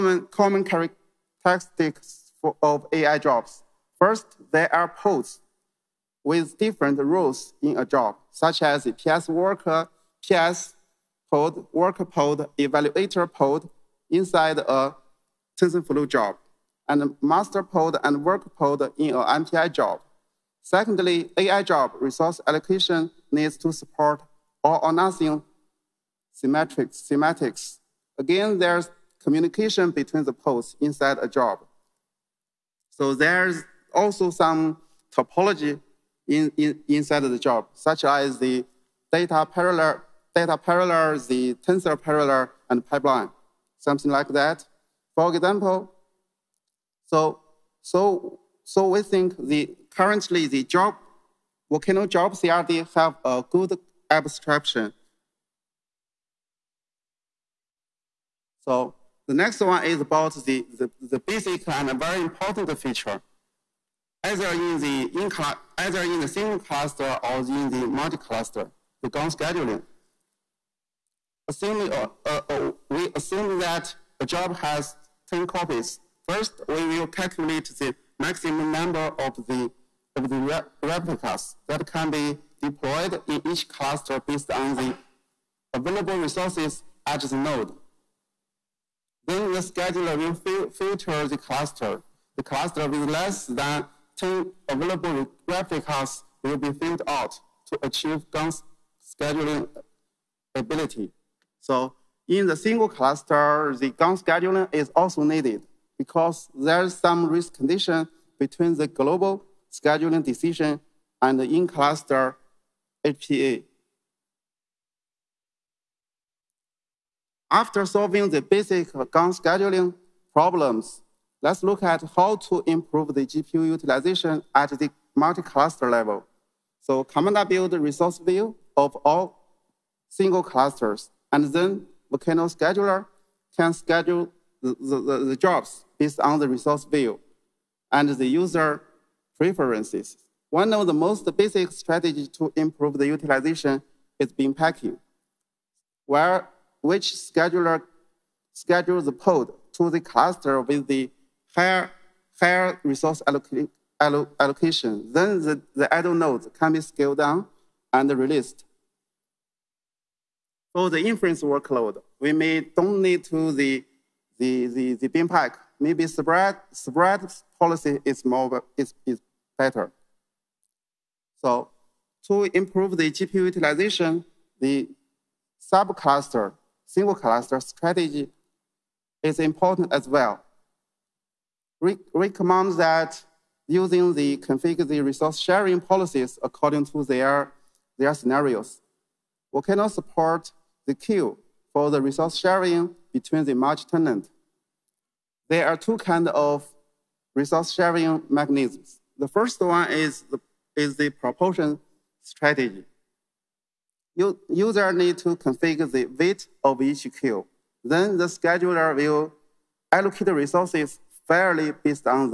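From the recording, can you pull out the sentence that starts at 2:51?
So to improve the GPU utilization, the subcluster single cluster strategy is important as well.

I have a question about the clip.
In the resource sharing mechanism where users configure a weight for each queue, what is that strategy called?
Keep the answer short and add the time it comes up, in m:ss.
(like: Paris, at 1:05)
proportion strategy, at 3:21.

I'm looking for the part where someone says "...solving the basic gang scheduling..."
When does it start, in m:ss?
1:57.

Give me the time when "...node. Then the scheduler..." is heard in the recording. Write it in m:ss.
1:27.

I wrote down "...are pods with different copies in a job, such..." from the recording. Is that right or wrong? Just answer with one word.
wrong.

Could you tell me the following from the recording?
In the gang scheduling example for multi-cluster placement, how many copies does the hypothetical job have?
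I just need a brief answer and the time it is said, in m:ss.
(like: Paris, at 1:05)
10, at 1:15.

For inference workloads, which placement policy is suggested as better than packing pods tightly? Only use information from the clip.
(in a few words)
spread policy.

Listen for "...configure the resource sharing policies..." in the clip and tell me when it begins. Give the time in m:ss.
3:04.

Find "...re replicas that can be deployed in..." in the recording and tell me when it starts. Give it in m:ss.
1:20.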